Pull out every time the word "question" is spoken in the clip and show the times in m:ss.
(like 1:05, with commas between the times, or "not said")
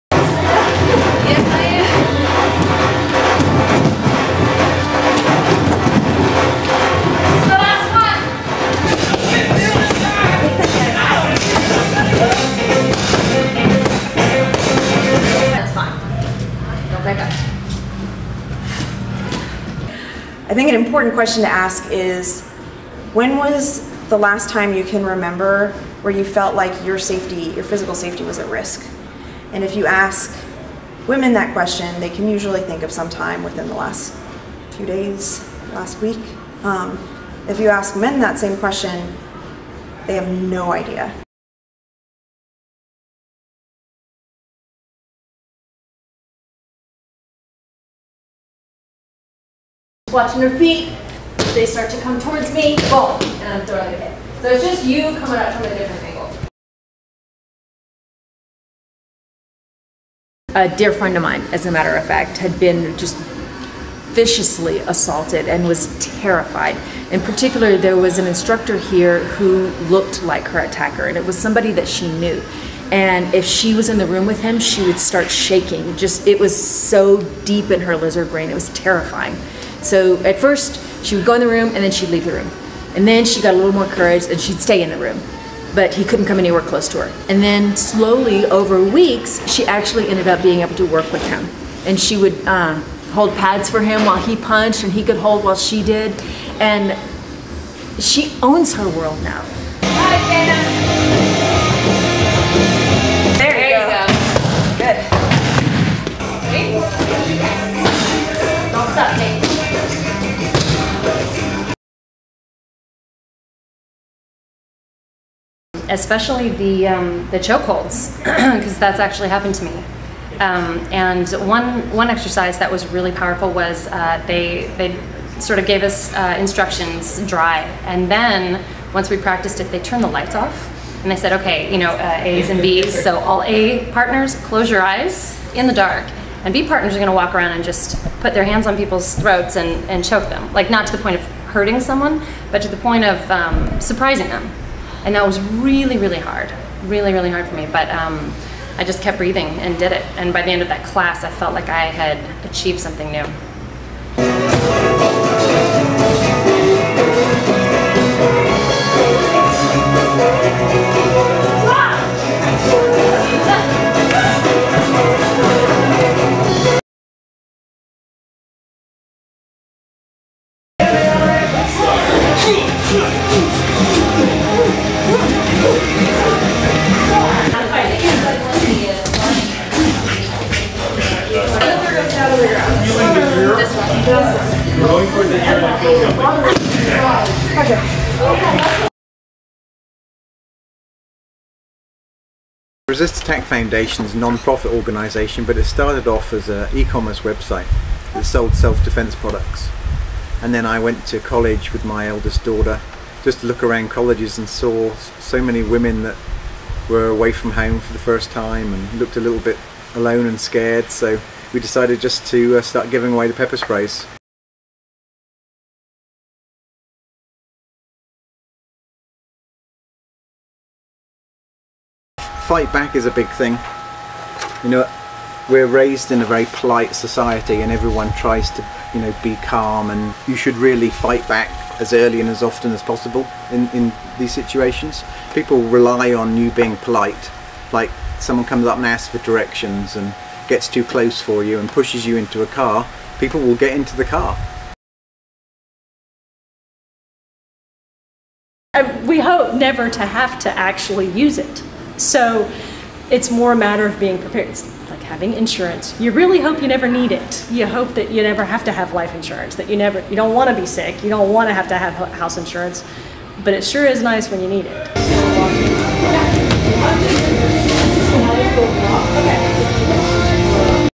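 0:21, 0:31, 0:38.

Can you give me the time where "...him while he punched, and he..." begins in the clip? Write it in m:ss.
1:33.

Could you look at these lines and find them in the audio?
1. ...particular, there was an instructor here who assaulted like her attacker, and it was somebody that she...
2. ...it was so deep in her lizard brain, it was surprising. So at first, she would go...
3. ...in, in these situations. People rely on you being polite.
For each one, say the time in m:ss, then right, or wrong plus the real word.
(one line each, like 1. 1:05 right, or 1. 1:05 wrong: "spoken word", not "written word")
1. 1:07 wrong: "looked", not "assaulted"
2. 1:16 wrong: "terrifying", not "surprising"
3. 3:53 right.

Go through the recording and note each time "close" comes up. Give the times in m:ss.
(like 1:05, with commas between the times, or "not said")
1:26, 2:14, 4:00.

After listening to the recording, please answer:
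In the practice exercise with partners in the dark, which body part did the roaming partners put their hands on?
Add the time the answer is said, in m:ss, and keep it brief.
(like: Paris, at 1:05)
Throats, at 2:19.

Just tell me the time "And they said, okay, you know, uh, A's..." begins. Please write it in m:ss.
2:11.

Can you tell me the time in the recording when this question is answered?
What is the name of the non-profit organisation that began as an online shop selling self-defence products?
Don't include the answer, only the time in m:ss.
3:12.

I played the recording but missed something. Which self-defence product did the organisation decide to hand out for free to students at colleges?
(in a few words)
Pepper sprays.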